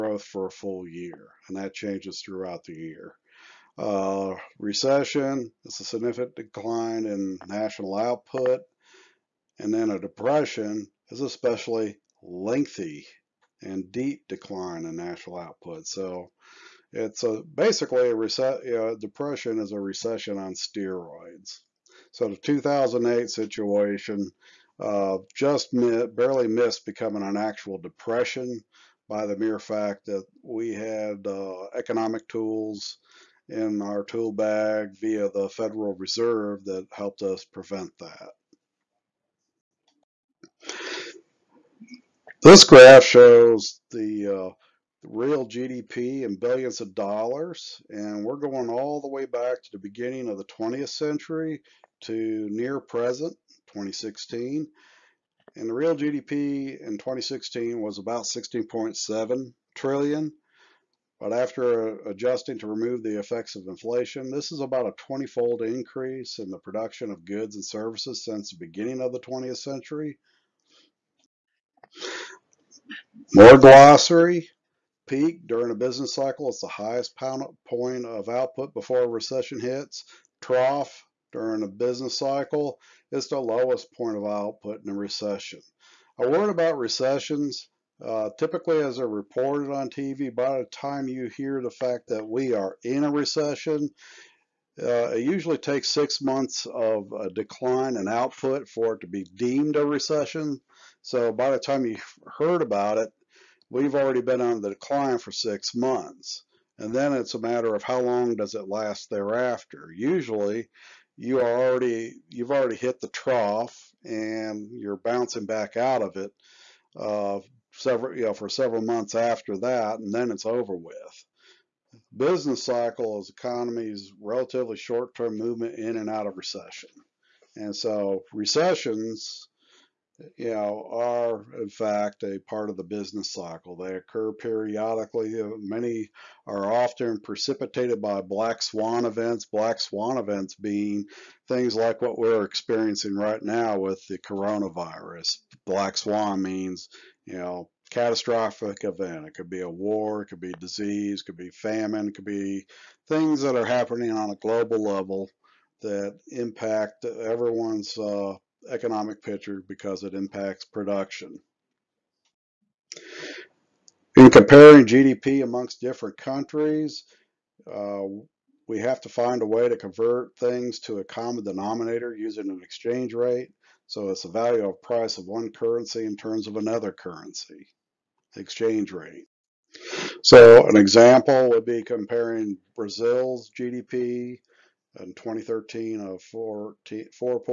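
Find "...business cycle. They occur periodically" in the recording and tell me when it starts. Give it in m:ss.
2:12.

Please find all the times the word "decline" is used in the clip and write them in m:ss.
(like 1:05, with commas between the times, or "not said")
0:06, 0:14, 1:37, 1:44.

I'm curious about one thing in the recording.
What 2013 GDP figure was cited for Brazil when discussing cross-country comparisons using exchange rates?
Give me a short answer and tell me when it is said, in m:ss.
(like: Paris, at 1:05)
4.4 trillion, at 3:06.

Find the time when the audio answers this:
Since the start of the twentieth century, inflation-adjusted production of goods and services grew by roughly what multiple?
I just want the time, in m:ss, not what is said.
1:05.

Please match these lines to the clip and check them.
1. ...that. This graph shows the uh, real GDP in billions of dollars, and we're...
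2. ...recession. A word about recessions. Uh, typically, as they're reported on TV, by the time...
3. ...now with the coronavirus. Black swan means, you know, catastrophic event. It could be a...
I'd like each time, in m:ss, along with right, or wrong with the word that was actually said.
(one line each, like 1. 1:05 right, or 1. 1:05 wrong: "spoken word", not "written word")
1. 0:37 right
2. 1:24 right
3. 2:23 right.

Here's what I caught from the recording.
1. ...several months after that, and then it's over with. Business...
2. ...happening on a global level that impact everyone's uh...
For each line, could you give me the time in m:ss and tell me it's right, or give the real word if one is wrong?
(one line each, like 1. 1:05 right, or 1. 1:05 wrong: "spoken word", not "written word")
1. 1:58 right
2. 2:33 right.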